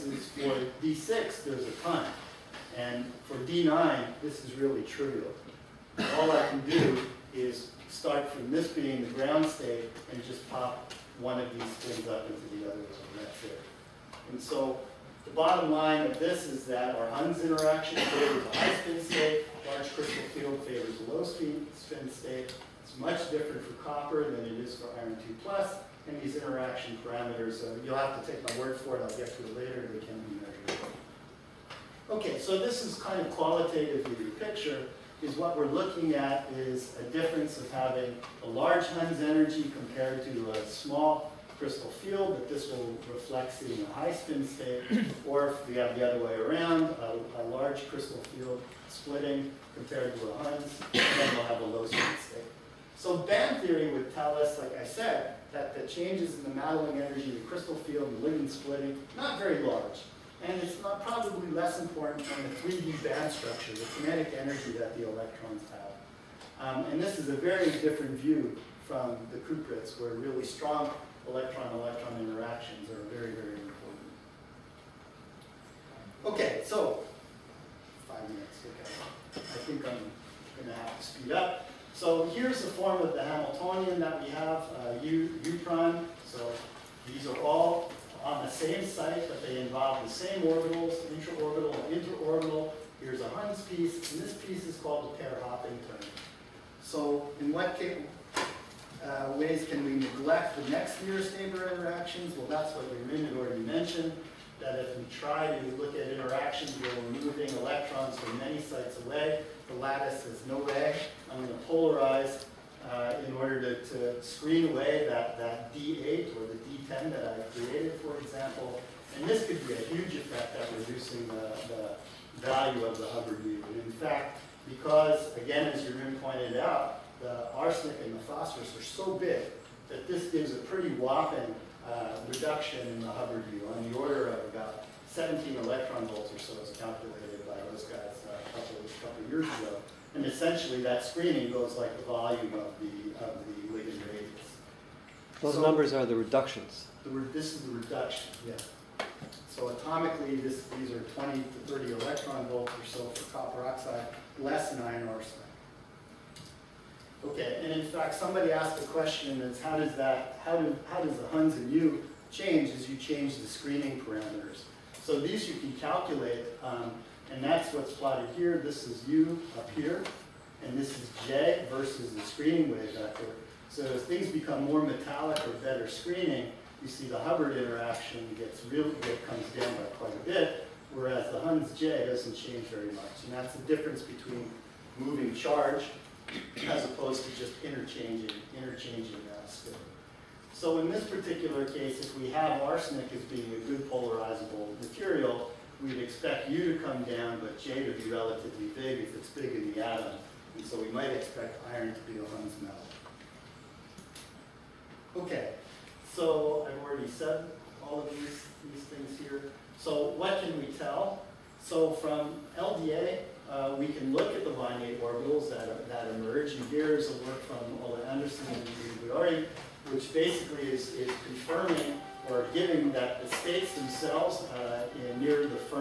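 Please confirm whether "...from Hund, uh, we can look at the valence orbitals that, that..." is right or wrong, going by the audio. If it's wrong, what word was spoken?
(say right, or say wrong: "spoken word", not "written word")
wrong: "LDA", not "Hund".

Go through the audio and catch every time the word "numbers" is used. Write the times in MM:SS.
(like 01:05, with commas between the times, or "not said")
02:25.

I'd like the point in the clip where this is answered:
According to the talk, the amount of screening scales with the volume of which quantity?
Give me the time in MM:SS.
02:23.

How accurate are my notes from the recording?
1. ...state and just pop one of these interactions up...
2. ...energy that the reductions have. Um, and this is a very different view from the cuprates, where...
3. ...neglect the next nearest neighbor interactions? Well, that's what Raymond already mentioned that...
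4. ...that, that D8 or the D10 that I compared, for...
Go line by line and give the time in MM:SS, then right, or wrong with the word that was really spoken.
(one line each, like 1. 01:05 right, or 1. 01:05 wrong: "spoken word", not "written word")
1. 00:09 wrong: "spins", not "interactions"
2. 01:04 wrong: "electrons", not "reductions"
3. 01:39 right
4. 01:55 wrong: "created", not "compared".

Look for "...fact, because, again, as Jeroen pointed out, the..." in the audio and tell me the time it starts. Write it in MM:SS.
02:03.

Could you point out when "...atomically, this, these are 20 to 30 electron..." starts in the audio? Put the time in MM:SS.
02:29.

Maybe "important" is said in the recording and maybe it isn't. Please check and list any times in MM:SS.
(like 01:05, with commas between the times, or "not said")
01:01, 01:13.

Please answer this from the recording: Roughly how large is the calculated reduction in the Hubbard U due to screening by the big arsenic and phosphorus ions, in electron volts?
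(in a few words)
17 electron volts.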